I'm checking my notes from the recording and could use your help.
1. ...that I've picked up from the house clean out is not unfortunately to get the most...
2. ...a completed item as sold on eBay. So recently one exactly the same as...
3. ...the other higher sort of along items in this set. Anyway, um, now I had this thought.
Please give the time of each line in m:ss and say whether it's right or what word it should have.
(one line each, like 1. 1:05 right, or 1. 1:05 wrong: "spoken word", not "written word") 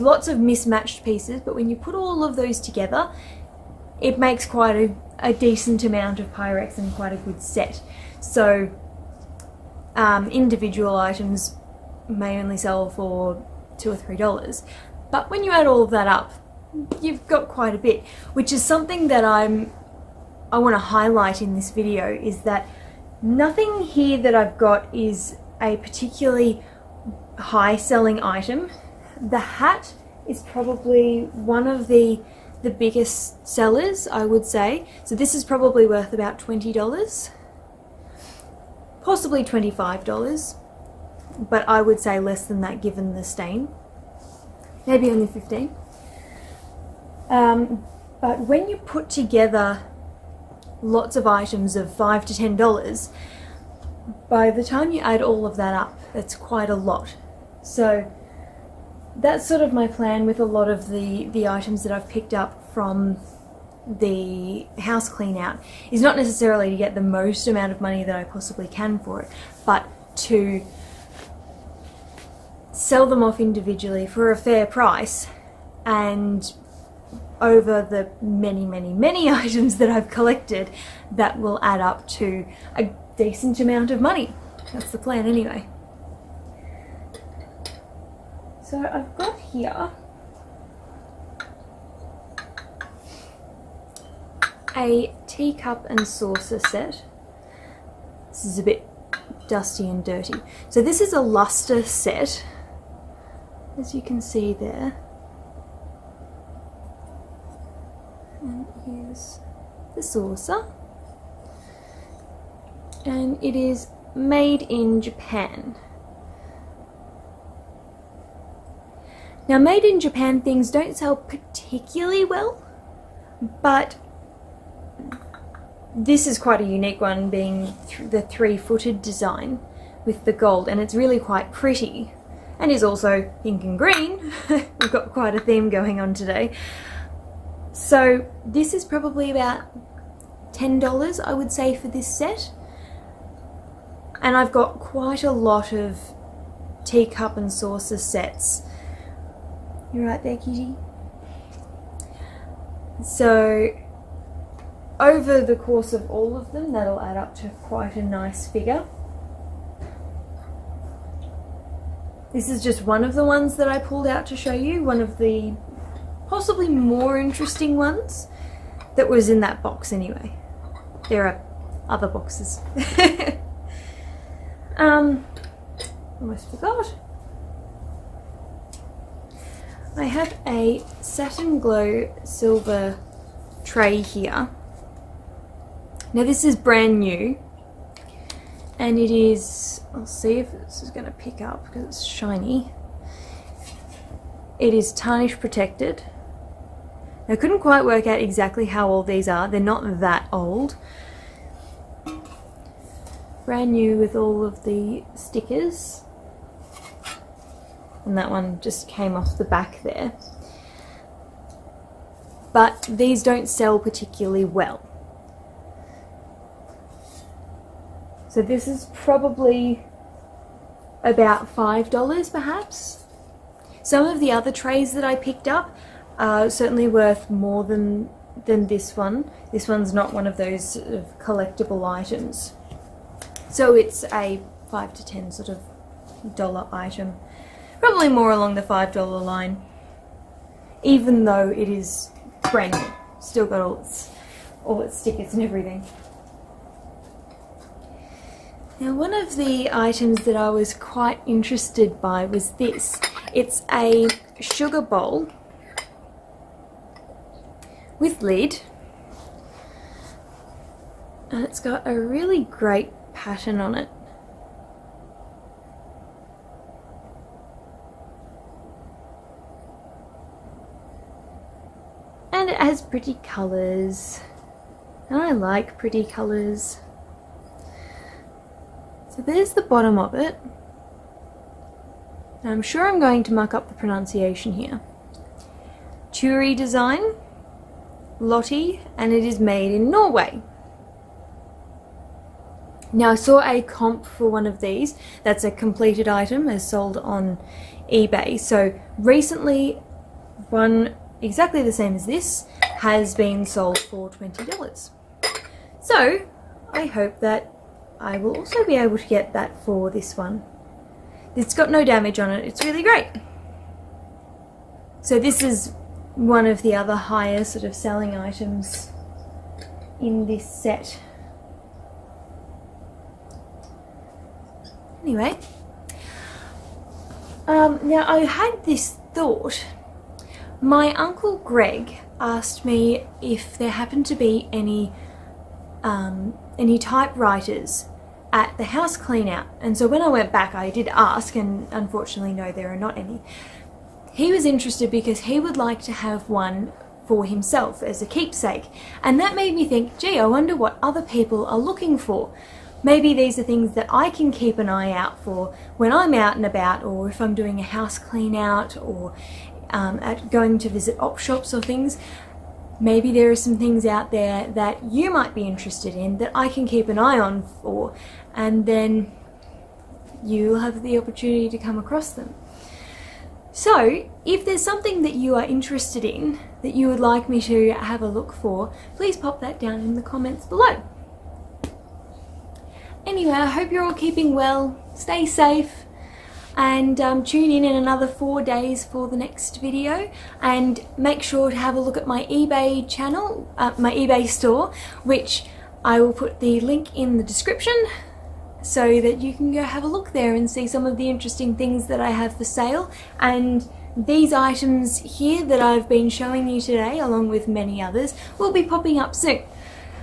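1. 1:01 wrong: "necessarily", not "unfortunately"
2. 4:55 right
3. 5:16 wrong: "selling", not "along".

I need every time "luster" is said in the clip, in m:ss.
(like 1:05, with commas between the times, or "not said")
1:41.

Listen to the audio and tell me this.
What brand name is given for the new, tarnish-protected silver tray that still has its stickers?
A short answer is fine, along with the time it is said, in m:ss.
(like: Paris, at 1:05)
Satin Glow, at 3:01.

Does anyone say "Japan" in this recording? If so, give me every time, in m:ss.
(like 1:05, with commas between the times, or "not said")
1:54, 1:59.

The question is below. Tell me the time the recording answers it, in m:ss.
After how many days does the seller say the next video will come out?
6:28.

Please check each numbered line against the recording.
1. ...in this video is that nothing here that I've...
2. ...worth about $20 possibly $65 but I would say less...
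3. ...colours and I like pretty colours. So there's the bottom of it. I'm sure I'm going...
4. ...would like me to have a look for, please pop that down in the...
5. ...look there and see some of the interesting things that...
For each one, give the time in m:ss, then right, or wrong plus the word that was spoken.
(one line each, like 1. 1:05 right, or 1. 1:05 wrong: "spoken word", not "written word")
1. 0:21 right
2. 0:35 wrong: "25", not "65"
3. 4:33 right
4. 6:16 right
5. 6:39 right.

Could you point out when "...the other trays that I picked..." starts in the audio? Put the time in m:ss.
3:44.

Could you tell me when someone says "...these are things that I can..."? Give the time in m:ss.
5:53.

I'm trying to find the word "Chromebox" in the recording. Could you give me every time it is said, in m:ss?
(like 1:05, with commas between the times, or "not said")
not said.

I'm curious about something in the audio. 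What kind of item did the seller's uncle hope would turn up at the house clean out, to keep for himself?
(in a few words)
Typewriters.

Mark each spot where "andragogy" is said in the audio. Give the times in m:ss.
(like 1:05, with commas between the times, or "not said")
not said.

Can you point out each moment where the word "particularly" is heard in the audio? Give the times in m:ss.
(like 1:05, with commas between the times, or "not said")
0:25, 2:01, 3:33.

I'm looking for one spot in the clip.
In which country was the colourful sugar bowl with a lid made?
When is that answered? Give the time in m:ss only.
4:49.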